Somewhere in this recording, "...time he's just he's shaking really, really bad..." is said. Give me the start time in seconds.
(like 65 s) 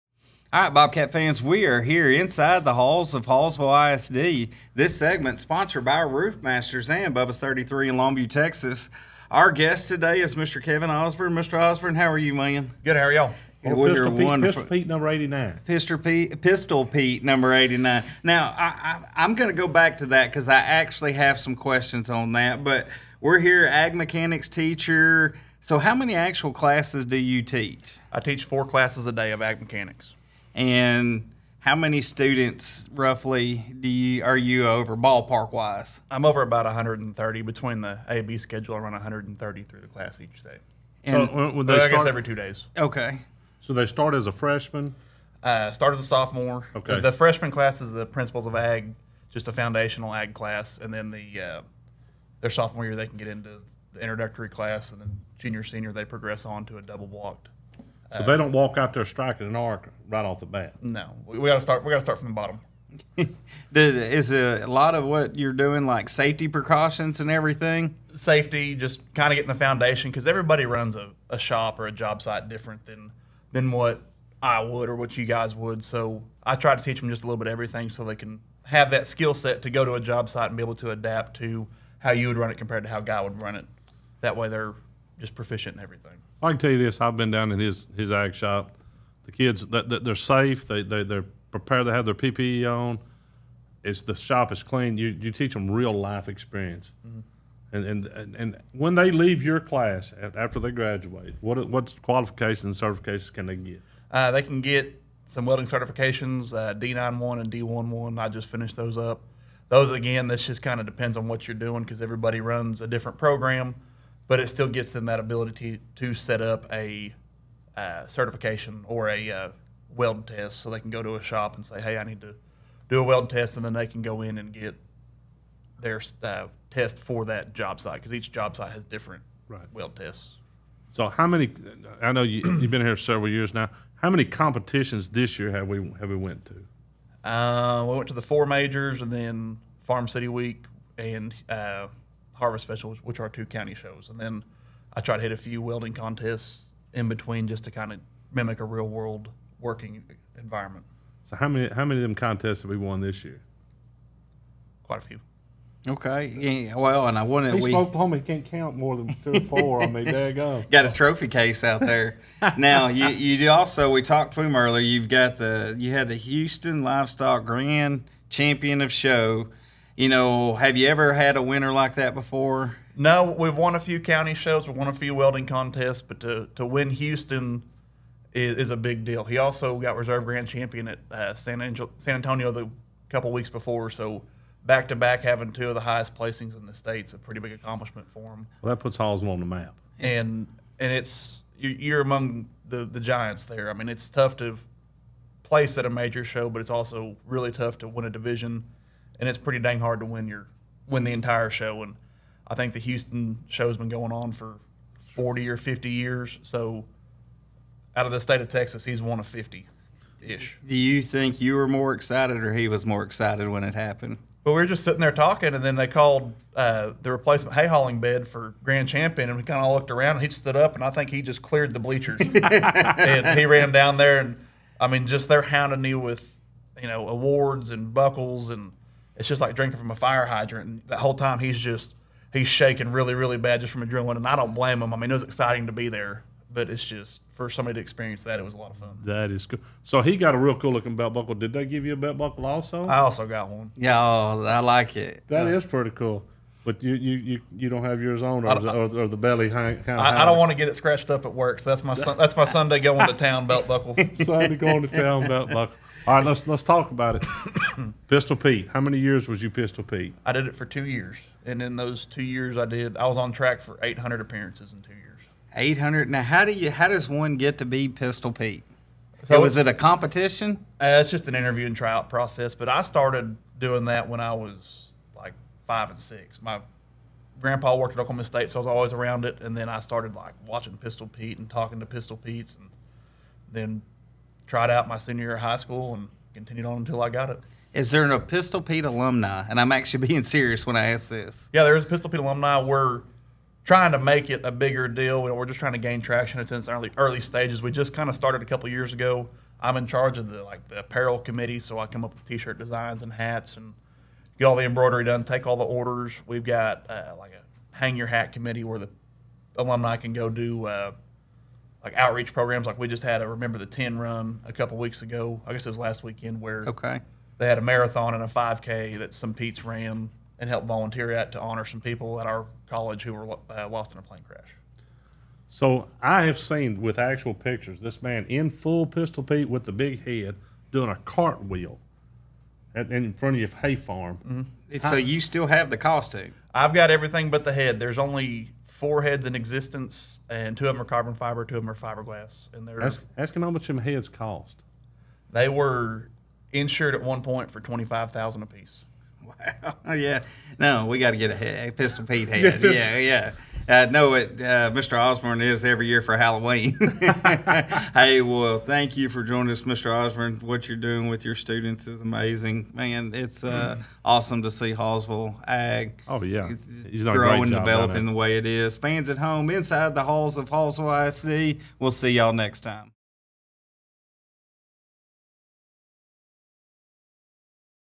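231 s.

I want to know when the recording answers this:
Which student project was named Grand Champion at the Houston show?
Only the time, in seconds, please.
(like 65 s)
217 s.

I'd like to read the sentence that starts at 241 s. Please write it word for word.
Did they give you a belt buckle also?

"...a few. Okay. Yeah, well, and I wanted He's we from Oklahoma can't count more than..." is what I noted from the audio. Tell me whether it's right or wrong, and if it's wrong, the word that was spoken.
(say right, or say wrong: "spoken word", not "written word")
right.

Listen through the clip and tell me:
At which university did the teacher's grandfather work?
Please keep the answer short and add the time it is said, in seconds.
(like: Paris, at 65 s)
Oklahoma State, at 277 s.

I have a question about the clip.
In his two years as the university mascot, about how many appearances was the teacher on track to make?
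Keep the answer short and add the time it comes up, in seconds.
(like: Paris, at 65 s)
800, at 263 s.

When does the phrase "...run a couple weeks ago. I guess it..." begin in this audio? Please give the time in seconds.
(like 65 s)
313 s.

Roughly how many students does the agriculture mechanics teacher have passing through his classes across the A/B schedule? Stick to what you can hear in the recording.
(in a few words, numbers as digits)
130.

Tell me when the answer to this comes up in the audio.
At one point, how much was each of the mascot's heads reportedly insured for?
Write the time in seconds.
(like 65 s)
347 s.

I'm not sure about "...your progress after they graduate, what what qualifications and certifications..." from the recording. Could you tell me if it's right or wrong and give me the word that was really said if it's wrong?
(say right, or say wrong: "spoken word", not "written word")
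wrong: "class", not "progress".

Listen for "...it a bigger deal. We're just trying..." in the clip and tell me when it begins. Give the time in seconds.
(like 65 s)
294 s.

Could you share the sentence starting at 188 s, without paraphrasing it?
Well, that puts Halls on the map, and and it's you're among the the giants there.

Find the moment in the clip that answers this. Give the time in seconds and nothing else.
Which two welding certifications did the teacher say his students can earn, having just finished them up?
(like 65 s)
106 s.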